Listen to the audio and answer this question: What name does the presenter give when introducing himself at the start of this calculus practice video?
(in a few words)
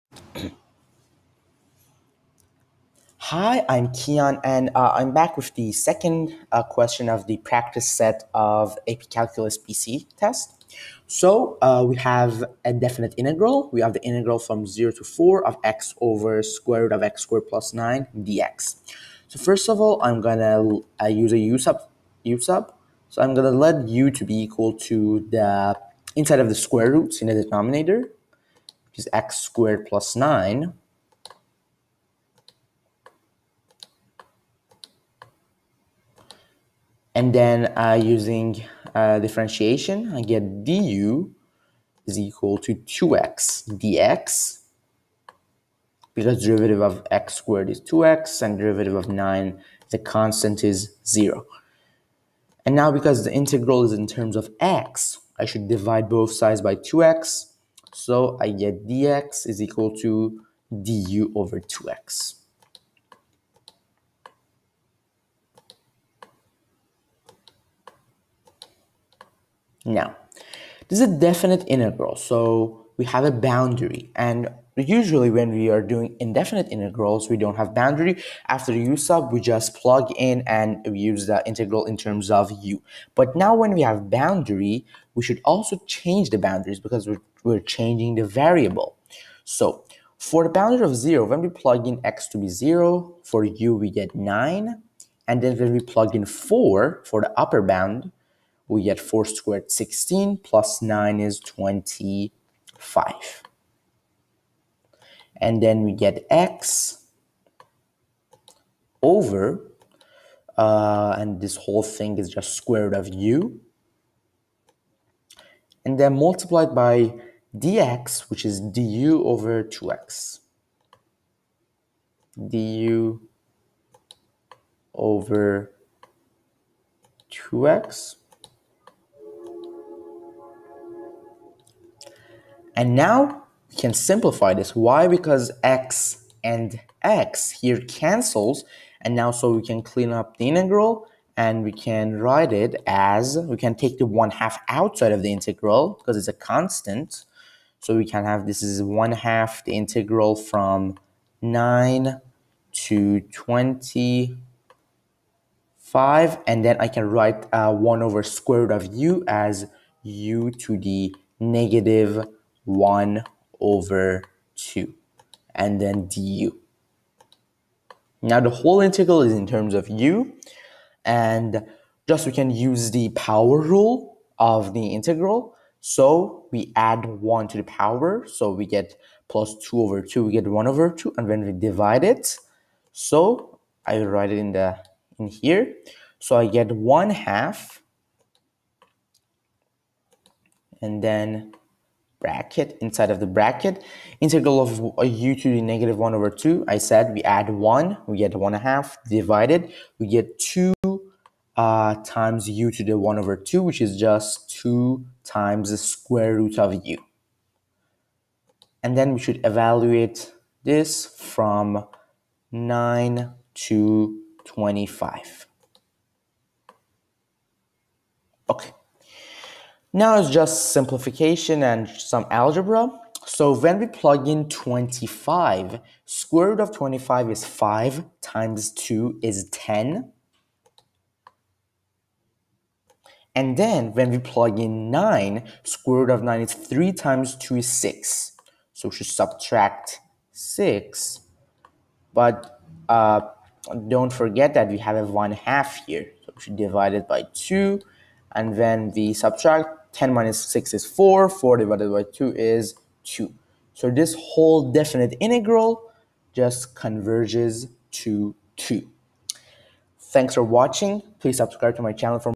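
Kian.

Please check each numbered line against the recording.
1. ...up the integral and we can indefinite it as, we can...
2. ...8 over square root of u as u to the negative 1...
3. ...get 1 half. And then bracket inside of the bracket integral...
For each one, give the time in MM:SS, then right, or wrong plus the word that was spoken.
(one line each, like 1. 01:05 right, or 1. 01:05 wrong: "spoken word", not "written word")
1. 02:20 wrong: "write", not "indefinite"
2. 02:37 wrong: "1", not "8"
3. 03:06 right.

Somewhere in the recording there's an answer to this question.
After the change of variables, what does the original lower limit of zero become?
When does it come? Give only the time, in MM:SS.
01:33.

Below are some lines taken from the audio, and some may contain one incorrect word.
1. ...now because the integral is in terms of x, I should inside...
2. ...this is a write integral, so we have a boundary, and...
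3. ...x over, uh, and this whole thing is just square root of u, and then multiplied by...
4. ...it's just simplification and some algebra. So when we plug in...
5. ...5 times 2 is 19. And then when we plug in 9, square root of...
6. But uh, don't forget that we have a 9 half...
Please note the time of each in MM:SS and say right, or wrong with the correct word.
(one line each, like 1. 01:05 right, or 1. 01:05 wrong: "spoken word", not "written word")
1. 00:52 wrong: "divide", not "inside"
2. 01:10 wrong: "definite", not "write"
3. 01:46 right
4. 03:40 right
5. 03:47 wrong: "10", not "19"
6. 04:02 wrong: "1", not "9".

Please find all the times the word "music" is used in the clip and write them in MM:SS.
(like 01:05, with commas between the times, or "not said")
not said.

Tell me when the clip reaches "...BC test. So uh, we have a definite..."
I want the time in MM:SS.
00:09.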